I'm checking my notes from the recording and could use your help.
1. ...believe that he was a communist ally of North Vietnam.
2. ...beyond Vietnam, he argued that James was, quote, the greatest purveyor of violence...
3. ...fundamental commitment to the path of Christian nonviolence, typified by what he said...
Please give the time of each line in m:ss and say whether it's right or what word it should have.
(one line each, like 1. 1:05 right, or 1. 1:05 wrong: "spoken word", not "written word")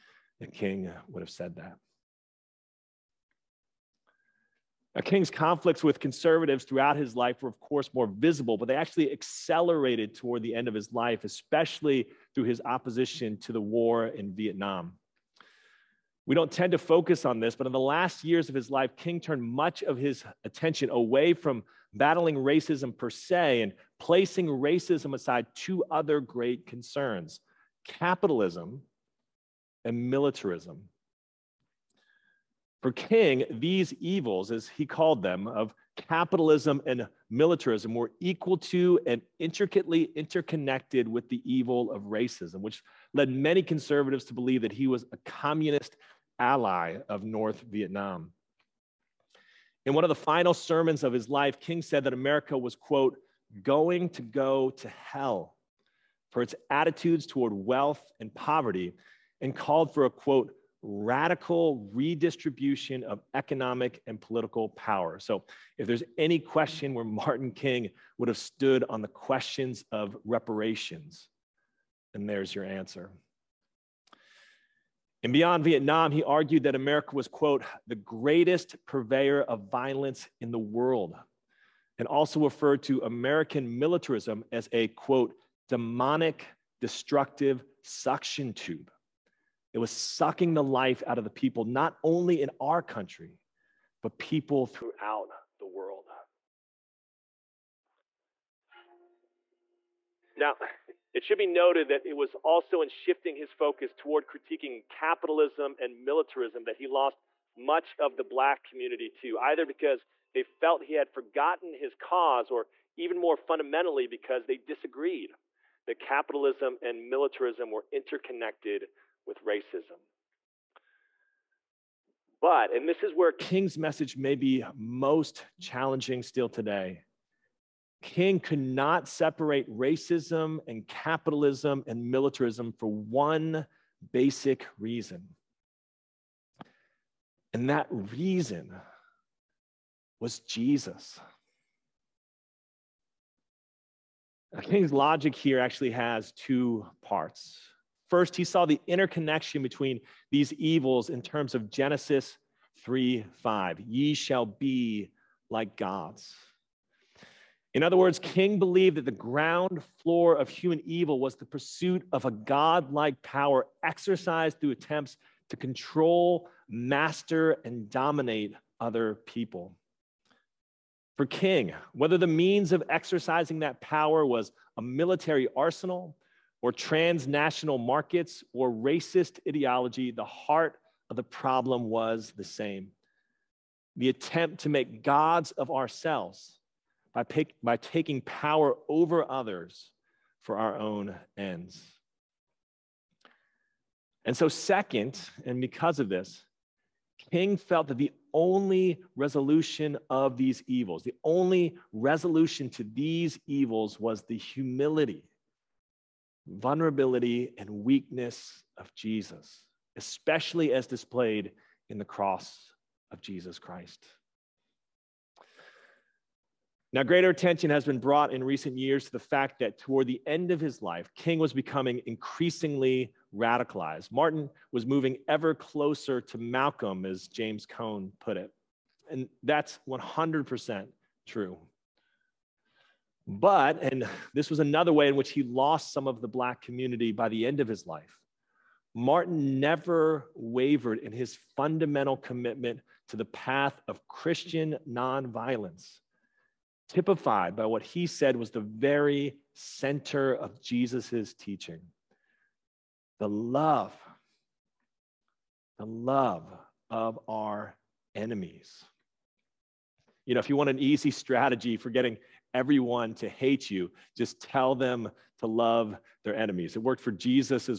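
1. 0:44 right
2. 1:15 wrong: "America", not "James"
3. 4:01 right.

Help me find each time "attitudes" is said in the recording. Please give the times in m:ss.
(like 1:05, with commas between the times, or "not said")
0:56.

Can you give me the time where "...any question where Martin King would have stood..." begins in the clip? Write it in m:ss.
1:06.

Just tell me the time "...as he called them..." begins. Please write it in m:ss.
0:34.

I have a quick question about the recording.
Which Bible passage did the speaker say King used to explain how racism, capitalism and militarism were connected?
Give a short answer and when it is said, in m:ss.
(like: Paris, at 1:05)
Genesis 3:5, at 2:31.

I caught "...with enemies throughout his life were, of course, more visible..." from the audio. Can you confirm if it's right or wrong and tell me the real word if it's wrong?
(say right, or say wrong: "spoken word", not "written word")
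wrong: "conservatives", not "enemies".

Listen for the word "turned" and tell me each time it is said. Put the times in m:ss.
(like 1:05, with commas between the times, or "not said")
0:19.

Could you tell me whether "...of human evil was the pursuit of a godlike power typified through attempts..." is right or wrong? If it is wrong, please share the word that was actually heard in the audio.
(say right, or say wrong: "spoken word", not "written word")
wrong: "exercised", not "typified".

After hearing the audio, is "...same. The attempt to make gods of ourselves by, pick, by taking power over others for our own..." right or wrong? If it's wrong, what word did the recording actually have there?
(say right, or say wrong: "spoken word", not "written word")
right.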